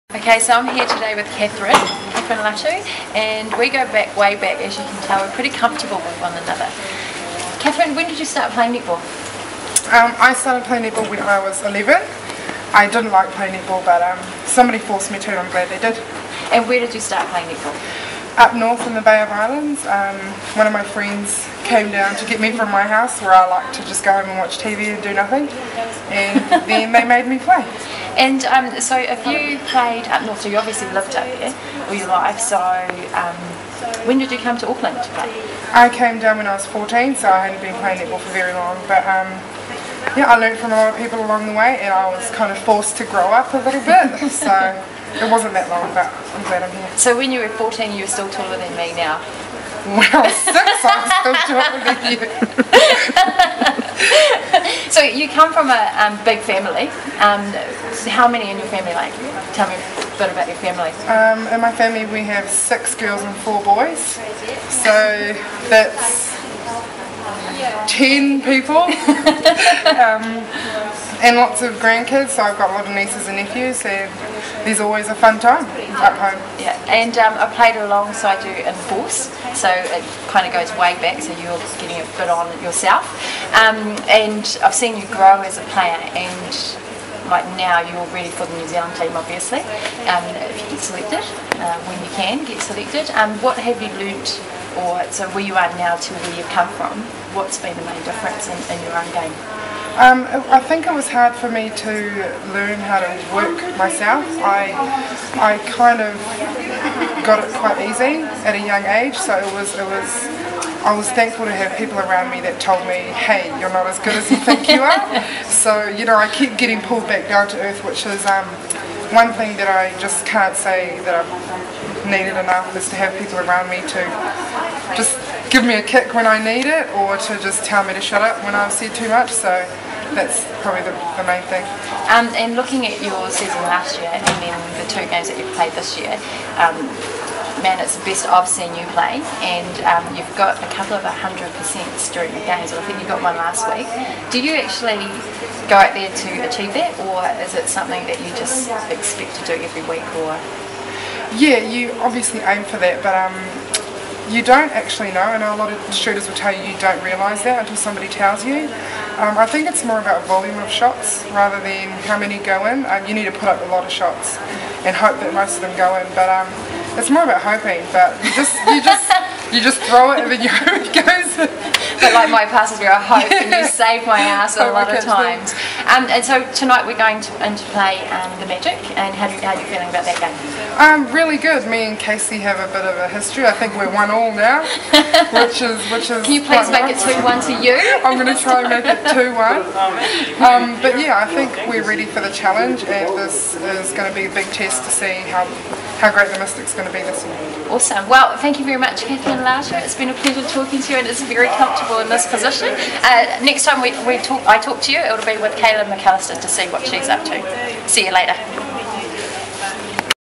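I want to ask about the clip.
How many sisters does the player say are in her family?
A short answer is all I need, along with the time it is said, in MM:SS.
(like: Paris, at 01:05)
6, at 01:02.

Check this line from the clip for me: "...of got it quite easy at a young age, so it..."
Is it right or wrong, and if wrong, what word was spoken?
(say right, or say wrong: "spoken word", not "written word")
right.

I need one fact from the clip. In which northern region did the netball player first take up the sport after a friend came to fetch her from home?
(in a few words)
Bay of Islands.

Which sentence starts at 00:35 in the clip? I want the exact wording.
I came down when I was 14, so I hadn't been playing netball for very long.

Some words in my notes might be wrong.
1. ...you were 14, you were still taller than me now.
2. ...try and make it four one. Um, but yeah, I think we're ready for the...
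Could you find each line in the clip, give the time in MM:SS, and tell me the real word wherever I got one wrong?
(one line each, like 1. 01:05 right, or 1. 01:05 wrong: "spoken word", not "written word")
1. 00:47 right
2. 03:08 wrong: "two", not "four".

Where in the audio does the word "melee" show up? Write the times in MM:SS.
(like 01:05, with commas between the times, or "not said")
not said.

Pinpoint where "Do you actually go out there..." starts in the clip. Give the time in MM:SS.
02:24.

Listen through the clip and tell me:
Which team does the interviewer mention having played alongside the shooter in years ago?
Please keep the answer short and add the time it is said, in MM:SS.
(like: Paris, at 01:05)
Force, at 01:18.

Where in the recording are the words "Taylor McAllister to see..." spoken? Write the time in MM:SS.
03:25.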